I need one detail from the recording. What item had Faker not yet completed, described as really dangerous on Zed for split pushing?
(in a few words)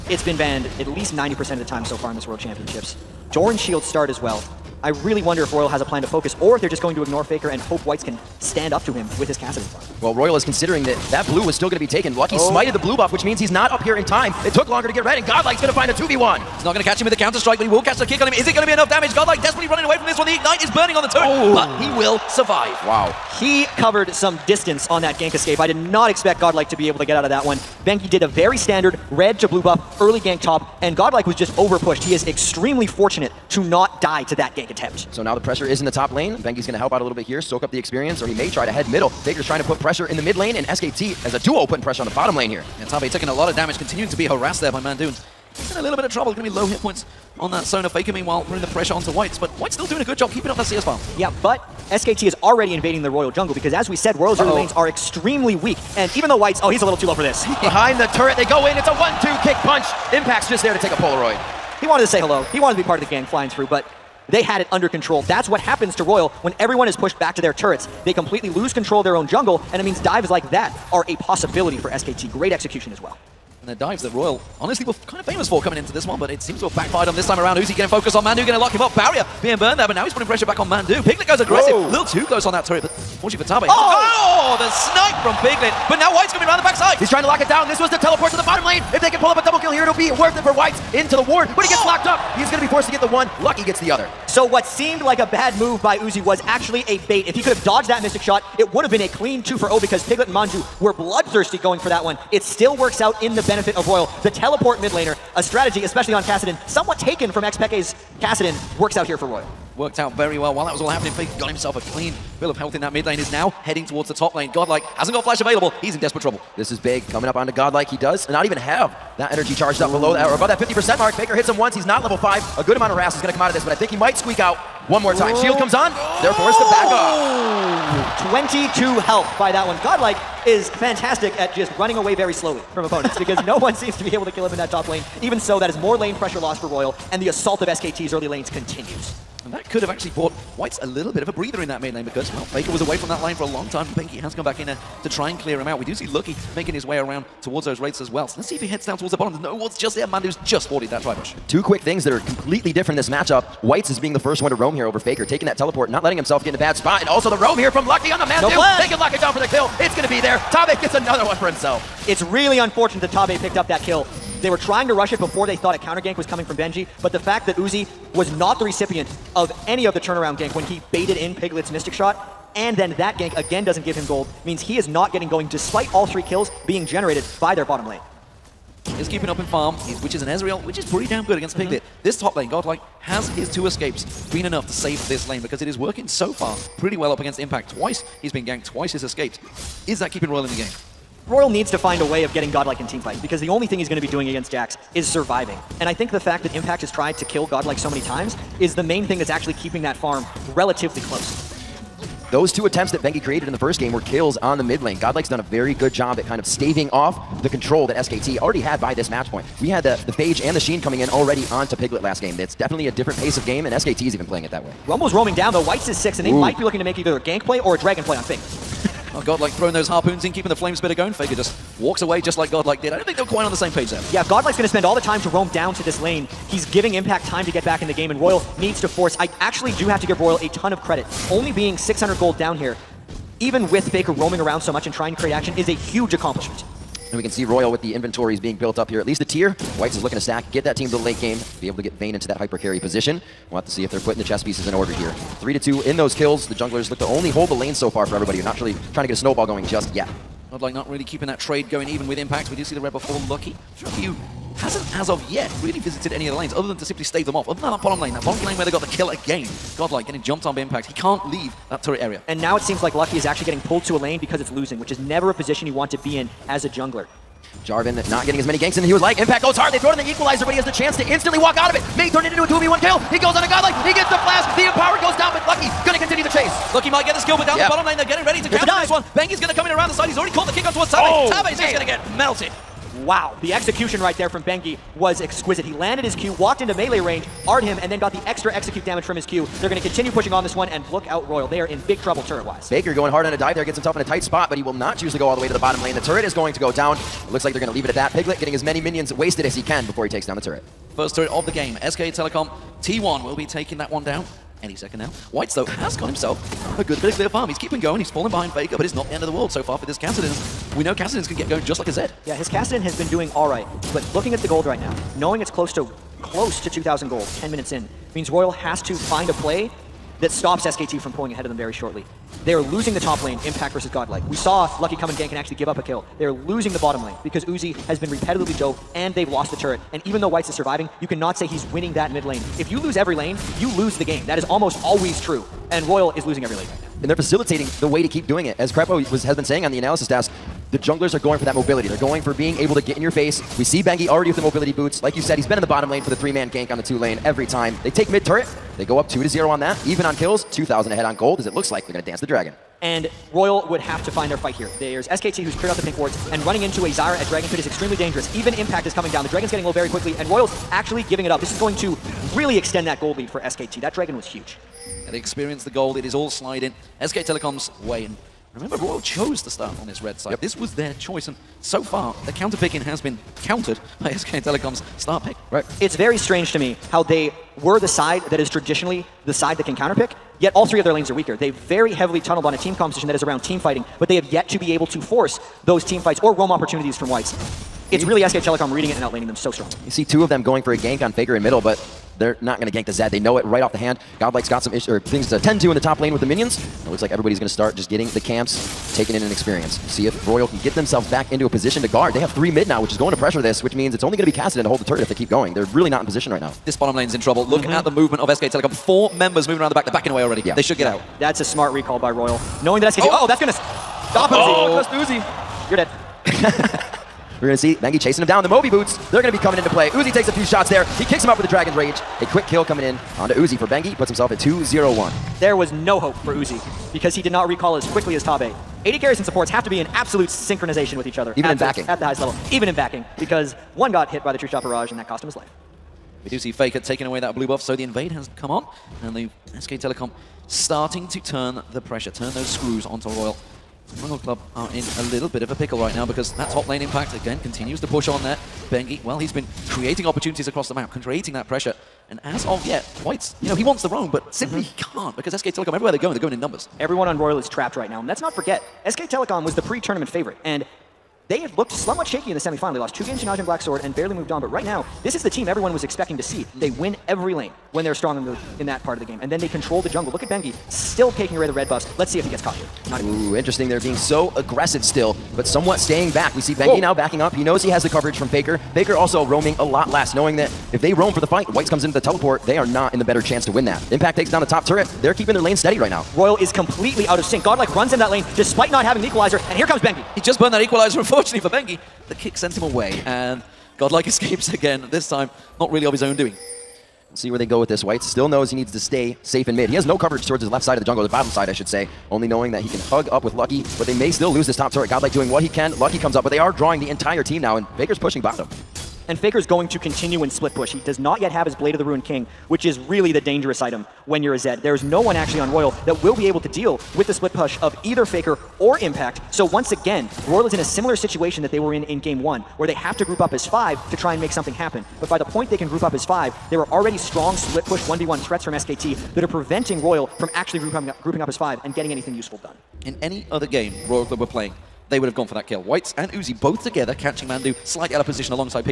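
Blade of the Ruined King.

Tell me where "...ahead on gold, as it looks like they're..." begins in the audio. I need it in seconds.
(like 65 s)
350 s.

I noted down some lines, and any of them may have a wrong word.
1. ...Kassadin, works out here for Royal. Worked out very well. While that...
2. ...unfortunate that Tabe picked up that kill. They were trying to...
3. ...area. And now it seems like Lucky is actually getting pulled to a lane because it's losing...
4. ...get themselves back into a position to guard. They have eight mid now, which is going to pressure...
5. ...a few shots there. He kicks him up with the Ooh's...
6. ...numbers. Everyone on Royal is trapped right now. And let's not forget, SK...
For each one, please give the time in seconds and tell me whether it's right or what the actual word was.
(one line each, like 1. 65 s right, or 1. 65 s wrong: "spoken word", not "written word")
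1. 108 s right
2. 162 s right
3. 261 s right
4. 400 s wrong: "three", not "eight"
5. 420 s wrong: "Dragon", not "Ooh"
6. 456 s right.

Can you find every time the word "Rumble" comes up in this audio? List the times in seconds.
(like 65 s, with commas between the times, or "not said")
214 s.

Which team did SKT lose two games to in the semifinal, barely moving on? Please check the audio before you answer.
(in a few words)
Najin Black Sword.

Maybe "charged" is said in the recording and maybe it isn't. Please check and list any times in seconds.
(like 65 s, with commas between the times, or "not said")
119 s.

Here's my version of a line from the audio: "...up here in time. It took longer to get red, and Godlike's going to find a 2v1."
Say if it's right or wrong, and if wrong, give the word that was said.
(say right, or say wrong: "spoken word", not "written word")
right.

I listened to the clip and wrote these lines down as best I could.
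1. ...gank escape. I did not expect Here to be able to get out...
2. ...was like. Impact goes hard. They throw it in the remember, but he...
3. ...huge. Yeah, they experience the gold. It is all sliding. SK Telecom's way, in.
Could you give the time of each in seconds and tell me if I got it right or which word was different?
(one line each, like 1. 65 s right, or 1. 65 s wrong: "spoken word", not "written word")
1. 25 s wrong: "Godlike", not "Here"
2. 268 s wrong: "equalizer", not "remember"
3. 364 s right.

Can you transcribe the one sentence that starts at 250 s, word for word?
Not like not really keeping that trade going even with impact.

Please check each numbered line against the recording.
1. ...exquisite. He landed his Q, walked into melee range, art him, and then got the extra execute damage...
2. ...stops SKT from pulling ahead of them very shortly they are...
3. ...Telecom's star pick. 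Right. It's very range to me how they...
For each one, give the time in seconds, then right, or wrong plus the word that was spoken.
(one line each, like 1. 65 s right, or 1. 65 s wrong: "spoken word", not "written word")
1. 285 s right
2. 320 s right
3. 374 s wrong: "strange", not "range".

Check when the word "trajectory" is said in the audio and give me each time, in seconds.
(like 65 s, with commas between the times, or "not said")
not said.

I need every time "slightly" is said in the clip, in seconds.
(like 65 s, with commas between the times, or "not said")
537 s.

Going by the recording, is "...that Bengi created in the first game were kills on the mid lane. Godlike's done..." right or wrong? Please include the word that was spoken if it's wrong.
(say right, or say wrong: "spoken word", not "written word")
right.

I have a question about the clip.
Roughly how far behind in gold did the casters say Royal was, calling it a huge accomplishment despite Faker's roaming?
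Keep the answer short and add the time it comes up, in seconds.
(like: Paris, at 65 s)
600 gold, at 231 s.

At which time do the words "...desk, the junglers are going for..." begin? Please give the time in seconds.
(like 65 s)
340 s.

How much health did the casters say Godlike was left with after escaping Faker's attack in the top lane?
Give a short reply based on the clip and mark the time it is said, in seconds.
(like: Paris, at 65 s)
22, at 128 s.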